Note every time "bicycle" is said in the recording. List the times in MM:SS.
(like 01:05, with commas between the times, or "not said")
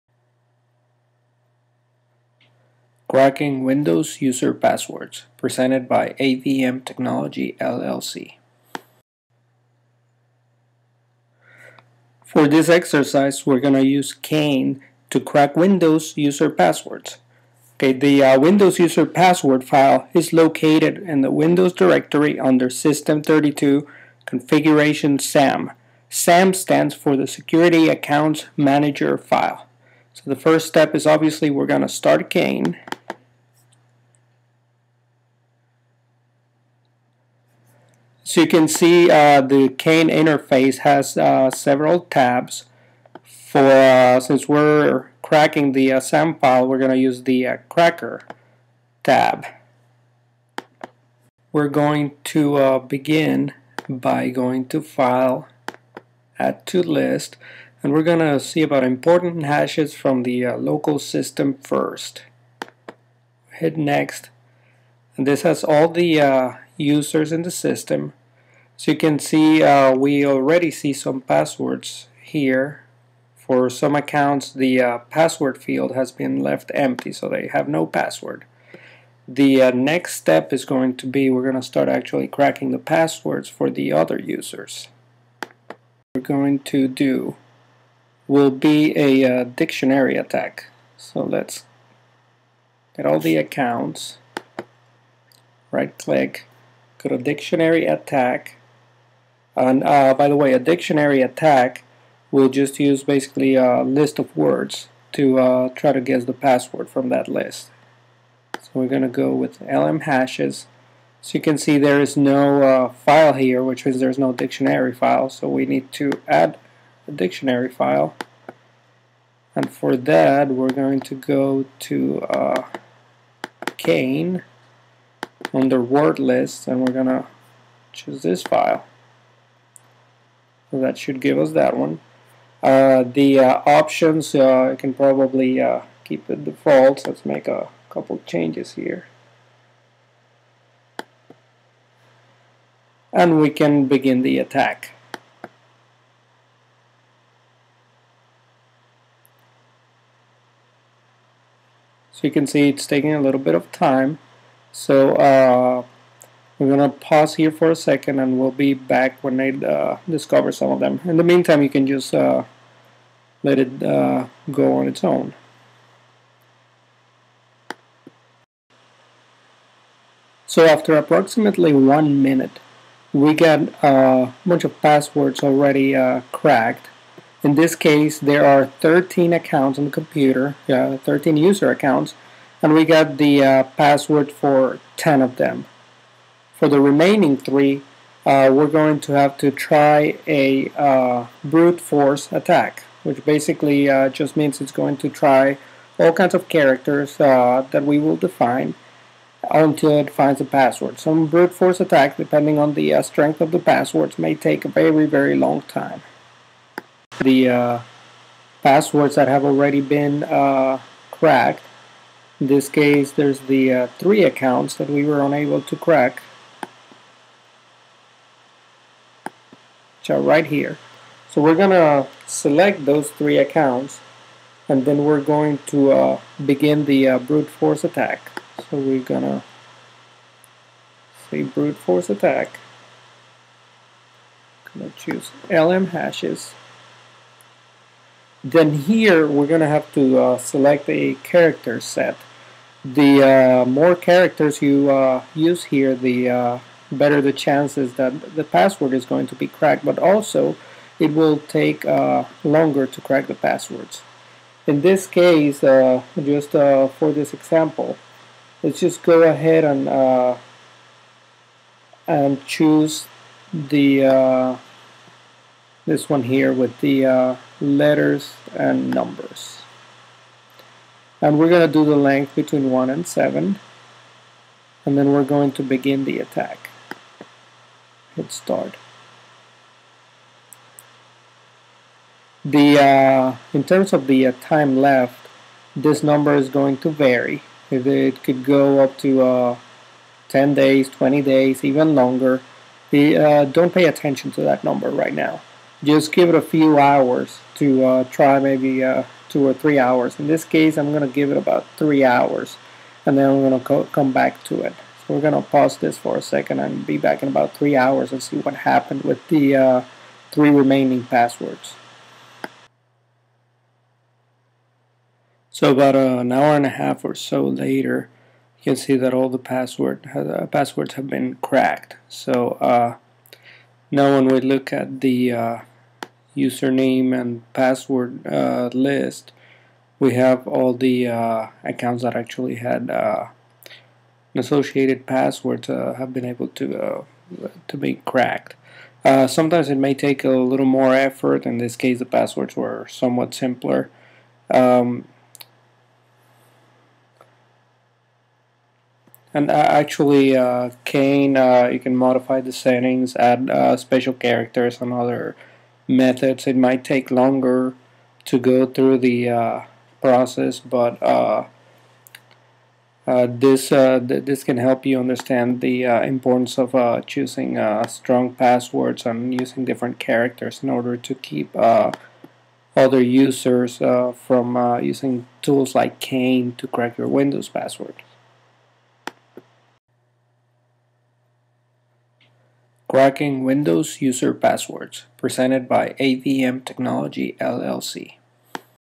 not said.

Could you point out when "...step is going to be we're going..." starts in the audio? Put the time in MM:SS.
01:20.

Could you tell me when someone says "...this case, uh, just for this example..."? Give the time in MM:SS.
04:14.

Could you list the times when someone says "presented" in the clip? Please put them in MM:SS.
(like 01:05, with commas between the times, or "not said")
00:05, 06:25.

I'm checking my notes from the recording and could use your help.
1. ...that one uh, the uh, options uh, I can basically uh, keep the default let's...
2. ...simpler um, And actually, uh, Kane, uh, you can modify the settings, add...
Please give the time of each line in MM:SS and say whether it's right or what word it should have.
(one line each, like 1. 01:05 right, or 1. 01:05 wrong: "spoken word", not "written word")
1. 02:11 wrong: "probably", not "basically"
2. 05:43 right.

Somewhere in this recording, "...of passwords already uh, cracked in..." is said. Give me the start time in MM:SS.
02:54.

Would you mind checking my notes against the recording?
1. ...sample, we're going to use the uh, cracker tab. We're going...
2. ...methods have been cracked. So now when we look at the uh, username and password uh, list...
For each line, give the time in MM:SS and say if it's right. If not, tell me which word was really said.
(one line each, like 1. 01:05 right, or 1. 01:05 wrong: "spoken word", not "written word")
1. 00:45 right
2. 05:20 wrong: "passwords", not "methods".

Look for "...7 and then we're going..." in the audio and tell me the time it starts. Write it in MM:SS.
04:33.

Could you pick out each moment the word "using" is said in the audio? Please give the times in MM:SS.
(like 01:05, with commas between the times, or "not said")
06:09, 06:14.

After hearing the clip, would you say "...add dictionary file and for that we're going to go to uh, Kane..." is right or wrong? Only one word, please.
right.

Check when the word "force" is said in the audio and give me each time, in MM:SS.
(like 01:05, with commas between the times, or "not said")
03:11, 03:21, 03:47, 03:51.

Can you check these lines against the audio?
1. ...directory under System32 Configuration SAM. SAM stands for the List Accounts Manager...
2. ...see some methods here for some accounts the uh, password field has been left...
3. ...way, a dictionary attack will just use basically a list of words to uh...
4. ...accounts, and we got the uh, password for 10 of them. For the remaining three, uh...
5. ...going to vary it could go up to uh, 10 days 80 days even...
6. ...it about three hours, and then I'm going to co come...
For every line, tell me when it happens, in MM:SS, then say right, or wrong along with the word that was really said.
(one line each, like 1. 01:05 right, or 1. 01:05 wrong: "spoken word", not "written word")
1. 00:21 wrong: "Security", not "List"
2. 01:10 wrong: "passwords", not "methods"
3. 01:40 right
4. 03:01 right
5. 04:46 wrong: "20", not "80"
6. 05:01 right.